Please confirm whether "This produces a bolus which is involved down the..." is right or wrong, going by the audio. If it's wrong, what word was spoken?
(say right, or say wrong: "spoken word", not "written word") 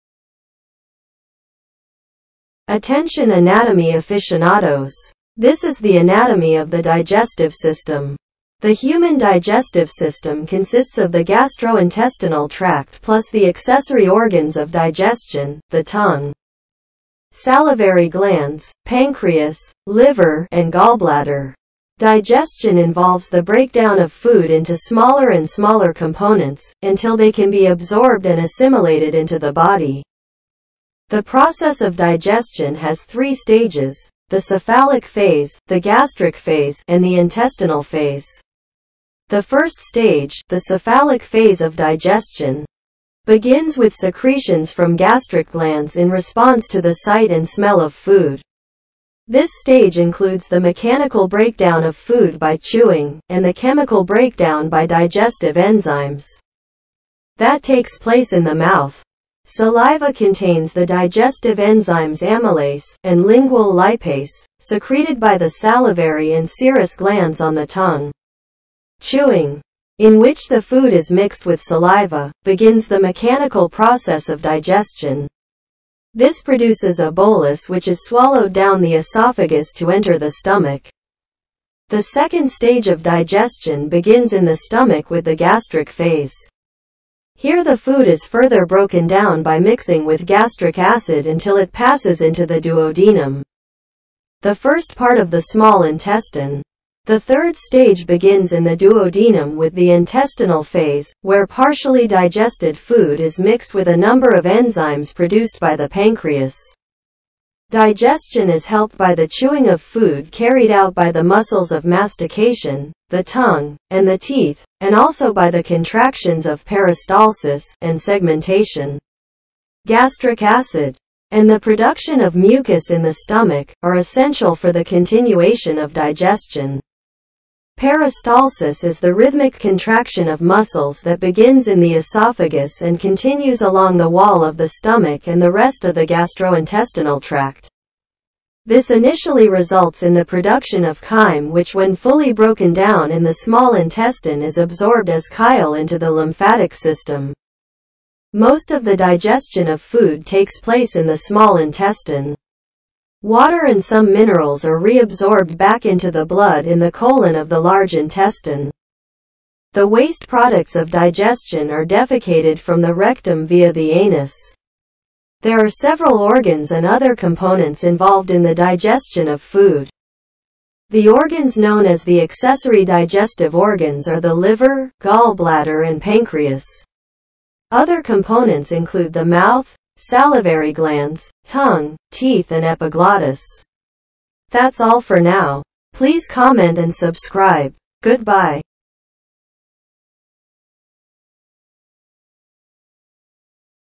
wrong: "swallowed", not "involved".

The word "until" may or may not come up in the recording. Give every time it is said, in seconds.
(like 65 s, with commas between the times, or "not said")
26 s, 91 s.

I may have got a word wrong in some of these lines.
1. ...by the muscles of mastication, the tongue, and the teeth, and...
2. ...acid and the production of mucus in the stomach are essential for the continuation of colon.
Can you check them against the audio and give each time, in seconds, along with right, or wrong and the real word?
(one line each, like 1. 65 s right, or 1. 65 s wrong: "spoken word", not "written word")
1. 110 s right
2. 120 s wrong: "digestion", not "colon".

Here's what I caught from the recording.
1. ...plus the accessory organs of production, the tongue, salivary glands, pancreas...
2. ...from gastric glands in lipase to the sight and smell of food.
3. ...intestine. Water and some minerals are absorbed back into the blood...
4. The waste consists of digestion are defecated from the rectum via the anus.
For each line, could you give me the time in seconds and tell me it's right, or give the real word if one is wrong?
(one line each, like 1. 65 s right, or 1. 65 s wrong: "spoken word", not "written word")
1. 13 s wrong: "digestion", not "production"
2. 44 s wrong: "response", not "lipase"
3. 151 s wrong: "reabsorbed", not "absorbed"
4. 159 s wrong: "products", not "consists".